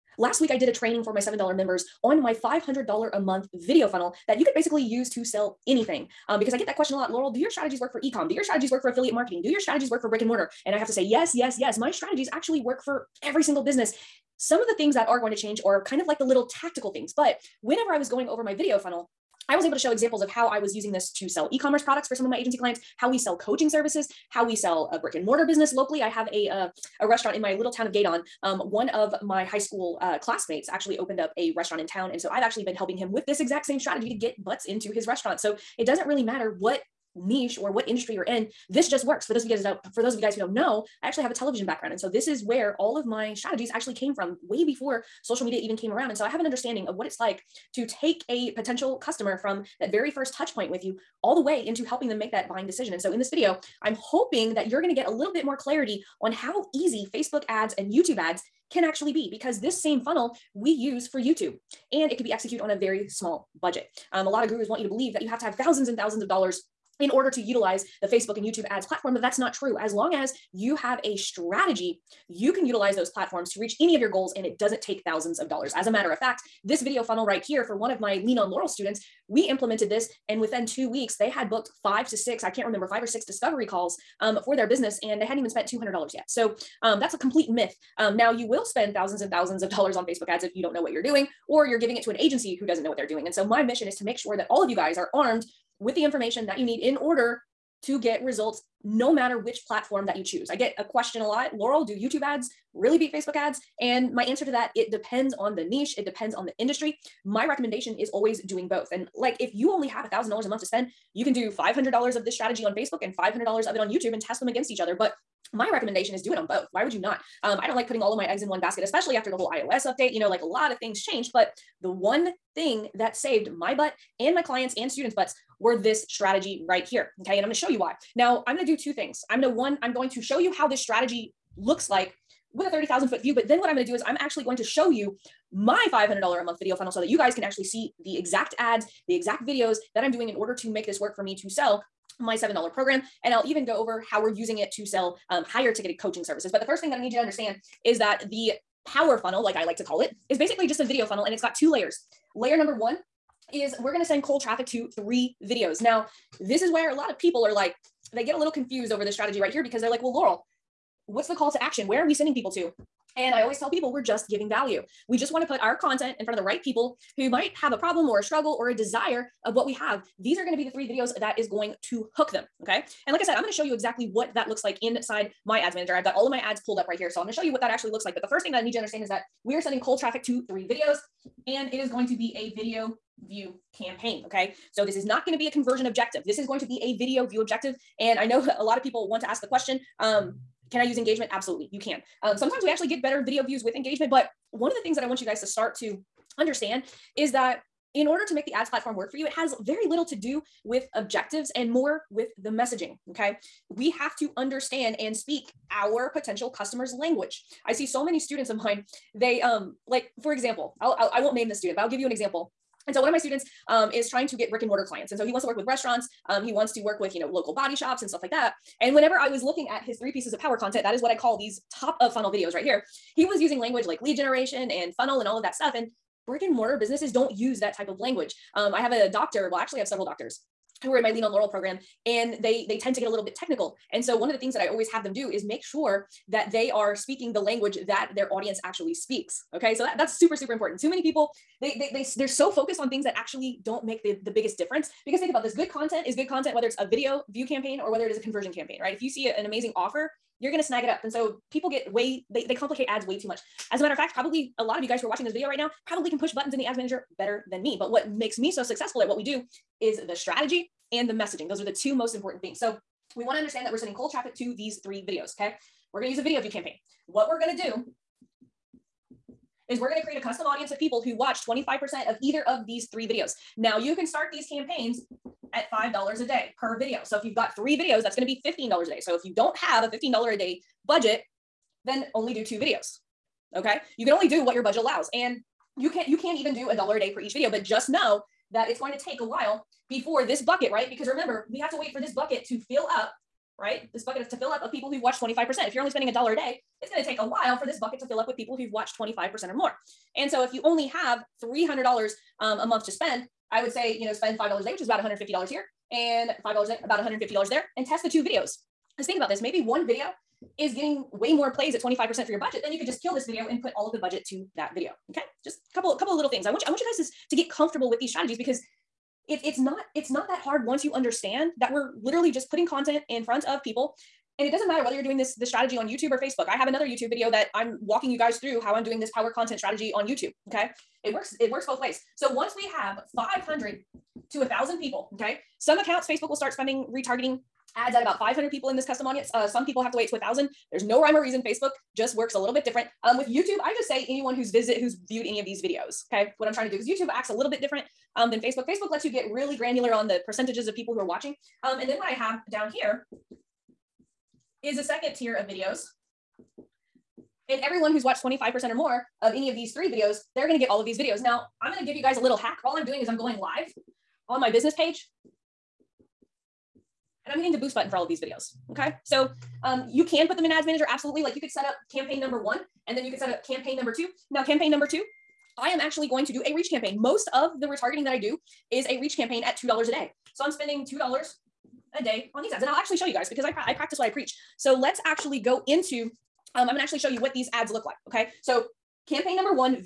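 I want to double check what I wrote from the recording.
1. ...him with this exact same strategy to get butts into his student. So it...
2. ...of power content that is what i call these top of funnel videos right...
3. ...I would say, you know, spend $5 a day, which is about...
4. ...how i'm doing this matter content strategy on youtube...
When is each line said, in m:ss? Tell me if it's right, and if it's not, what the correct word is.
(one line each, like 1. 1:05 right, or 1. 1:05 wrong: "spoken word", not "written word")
1. 0:32 wrong: "restaurant", not "student"
2. 3:40 right
3. 5:03 right
4. 5:28 wrong: "power", not "matter".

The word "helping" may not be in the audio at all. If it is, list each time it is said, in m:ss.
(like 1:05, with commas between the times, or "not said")
0:32, 0:51.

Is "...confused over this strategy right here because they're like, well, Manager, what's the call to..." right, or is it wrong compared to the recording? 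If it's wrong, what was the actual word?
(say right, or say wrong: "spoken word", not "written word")
wrong: "Laurel", not "Manager".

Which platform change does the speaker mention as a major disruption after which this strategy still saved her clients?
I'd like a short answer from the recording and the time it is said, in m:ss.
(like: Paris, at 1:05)
iOS update, at 1:59.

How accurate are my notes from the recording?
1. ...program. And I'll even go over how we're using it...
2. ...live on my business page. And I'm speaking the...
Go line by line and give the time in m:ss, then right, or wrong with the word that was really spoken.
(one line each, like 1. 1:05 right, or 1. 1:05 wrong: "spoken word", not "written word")
1. 2:22 right
2. 6:03 wrong: "hitting", not "speaking".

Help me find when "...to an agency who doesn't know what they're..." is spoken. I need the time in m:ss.
1:32.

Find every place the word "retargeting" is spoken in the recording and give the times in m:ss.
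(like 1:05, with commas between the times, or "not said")
5:36, 6:17.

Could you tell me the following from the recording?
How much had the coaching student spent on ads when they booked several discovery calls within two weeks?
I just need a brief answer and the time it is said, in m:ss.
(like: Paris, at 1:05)
under $200, at 1:25.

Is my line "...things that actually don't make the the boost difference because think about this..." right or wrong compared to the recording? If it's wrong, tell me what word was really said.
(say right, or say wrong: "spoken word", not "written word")
wrong: "biggest", not "boost".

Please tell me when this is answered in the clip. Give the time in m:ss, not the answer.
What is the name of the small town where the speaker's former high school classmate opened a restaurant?
0:27.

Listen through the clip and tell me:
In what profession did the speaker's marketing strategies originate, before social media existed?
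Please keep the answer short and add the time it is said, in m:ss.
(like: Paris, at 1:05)
television, at 0:41.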